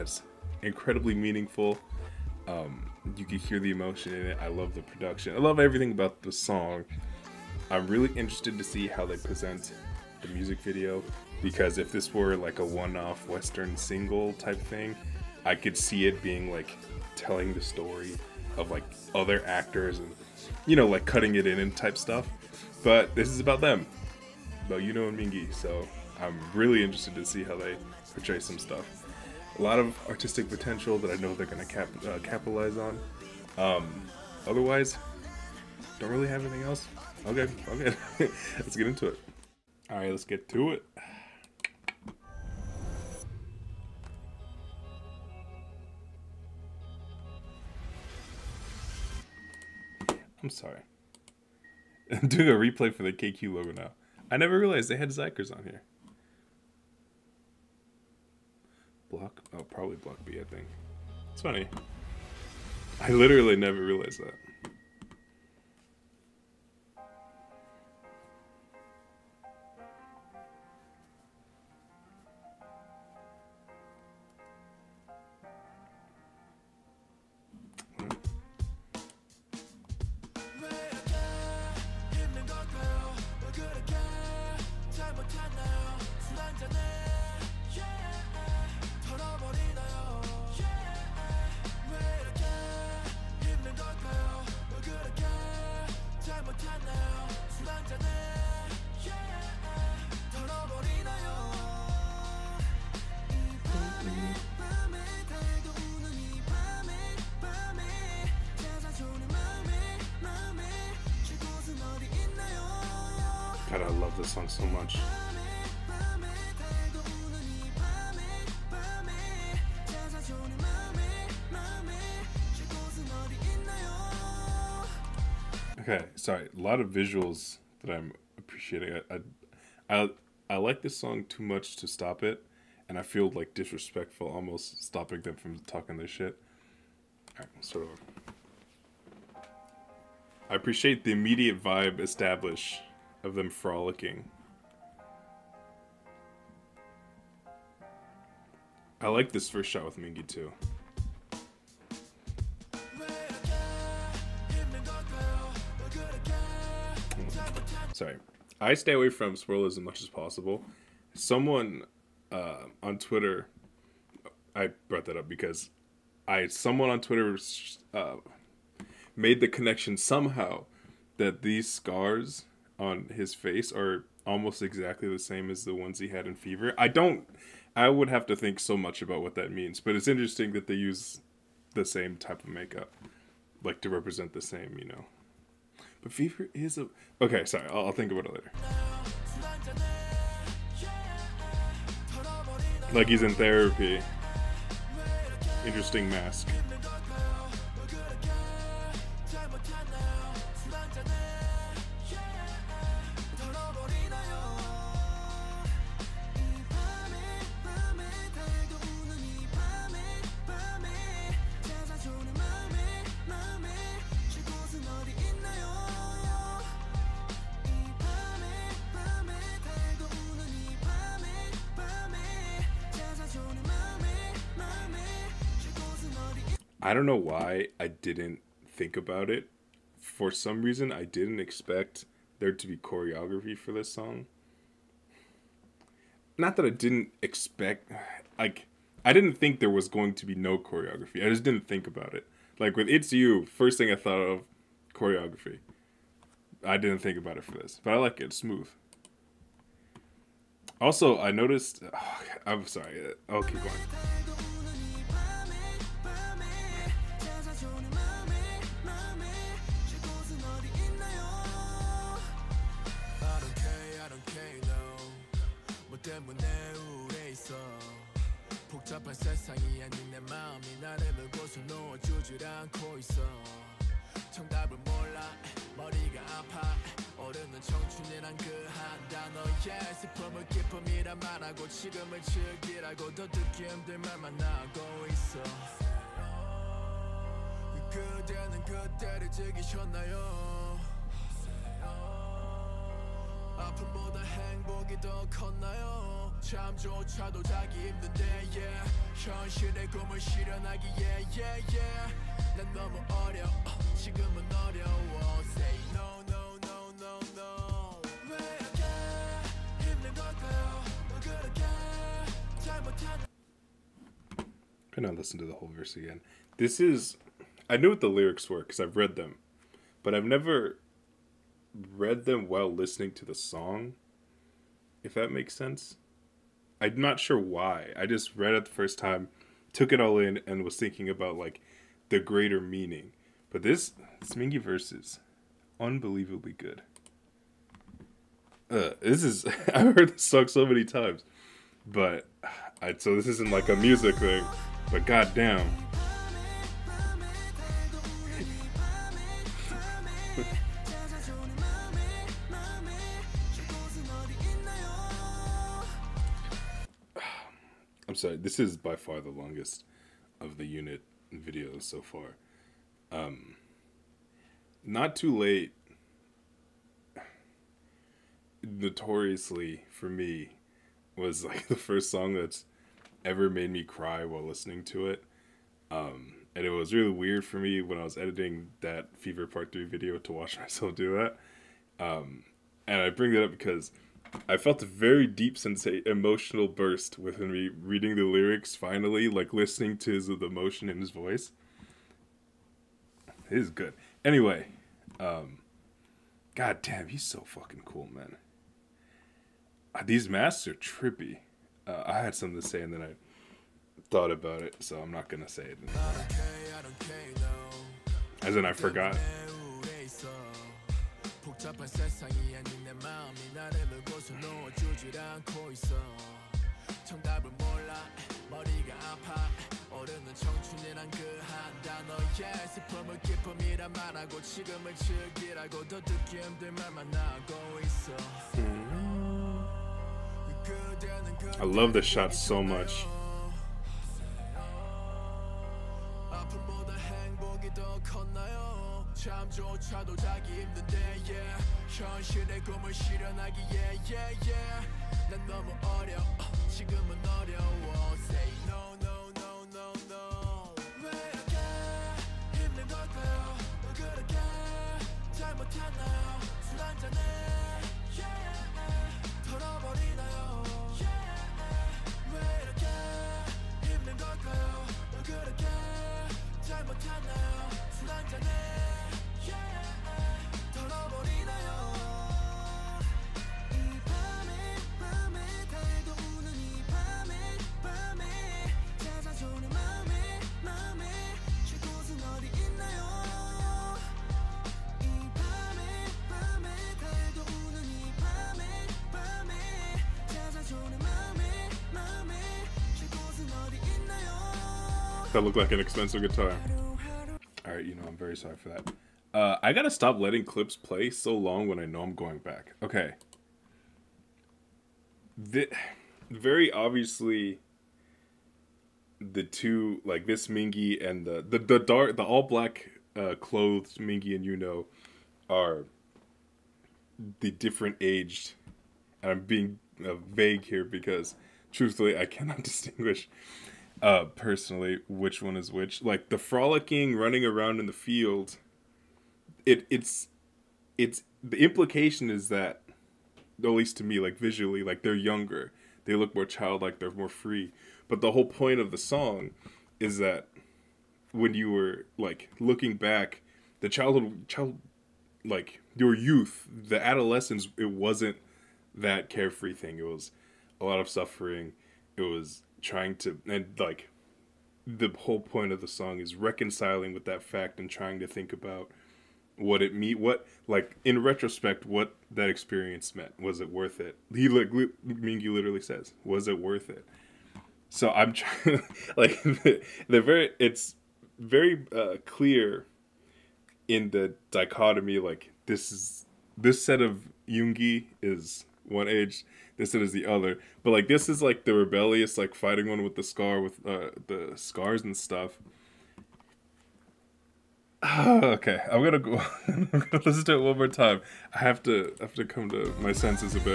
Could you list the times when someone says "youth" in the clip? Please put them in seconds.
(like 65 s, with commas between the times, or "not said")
546 s.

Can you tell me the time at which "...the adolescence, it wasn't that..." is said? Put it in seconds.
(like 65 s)
546 s.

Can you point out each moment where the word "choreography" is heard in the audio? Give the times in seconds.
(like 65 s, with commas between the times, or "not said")
232 s, 240 s, 244 s.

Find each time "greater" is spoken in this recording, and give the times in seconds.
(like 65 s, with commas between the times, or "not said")
332 s.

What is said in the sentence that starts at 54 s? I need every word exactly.
I never realized they had xikers on here.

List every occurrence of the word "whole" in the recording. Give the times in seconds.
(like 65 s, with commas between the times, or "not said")
315 s, 538 s, 555 s.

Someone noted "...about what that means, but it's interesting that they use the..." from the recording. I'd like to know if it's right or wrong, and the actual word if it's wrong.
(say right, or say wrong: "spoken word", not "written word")
right.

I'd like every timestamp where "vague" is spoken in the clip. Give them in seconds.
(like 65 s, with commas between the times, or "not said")
520 s.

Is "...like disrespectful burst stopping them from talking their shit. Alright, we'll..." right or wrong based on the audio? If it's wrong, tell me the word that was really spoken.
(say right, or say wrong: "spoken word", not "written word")
wrong: "almost", not "burst".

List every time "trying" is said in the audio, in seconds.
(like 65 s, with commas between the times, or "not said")
552 s, 557 s, 568 s.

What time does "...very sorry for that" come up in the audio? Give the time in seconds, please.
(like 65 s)
498 s.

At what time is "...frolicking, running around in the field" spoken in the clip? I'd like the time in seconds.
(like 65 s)
526 s.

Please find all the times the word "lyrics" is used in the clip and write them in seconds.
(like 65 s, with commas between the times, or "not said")
318 s, 388 s.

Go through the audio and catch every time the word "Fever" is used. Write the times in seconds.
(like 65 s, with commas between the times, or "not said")
176 s, 186 s, 379 s.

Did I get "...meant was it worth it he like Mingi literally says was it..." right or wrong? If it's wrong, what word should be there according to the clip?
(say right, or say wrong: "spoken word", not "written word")
right.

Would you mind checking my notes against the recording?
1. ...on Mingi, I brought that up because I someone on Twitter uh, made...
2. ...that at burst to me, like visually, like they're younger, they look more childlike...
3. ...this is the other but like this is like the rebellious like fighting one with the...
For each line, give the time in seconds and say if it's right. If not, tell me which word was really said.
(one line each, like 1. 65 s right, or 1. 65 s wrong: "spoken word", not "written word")
1. 162 s wrong: "Twitter", not "Mingi"
2. 532 s wrong: "least", not "burst"
3. 579 s right.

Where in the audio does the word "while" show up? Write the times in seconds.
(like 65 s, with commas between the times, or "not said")
322 s, 374 s.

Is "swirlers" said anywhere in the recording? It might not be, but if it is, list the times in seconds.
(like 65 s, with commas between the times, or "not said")
159 s.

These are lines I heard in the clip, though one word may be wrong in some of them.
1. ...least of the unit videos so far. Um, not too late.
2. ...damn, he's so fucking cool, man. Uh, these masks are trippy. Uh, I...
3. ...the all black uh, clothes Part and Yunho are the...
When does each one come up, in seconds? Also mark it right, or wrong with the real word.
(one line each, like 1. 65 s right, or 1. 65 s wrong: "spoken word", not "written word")
1. 359 s wrong: "longest", not "least"
2. 396 s right
3. 512 s wrong: "Mingi", not "Part".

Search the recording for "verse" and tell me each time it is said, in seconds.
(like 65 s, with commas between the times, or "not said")
315 s, 334 s.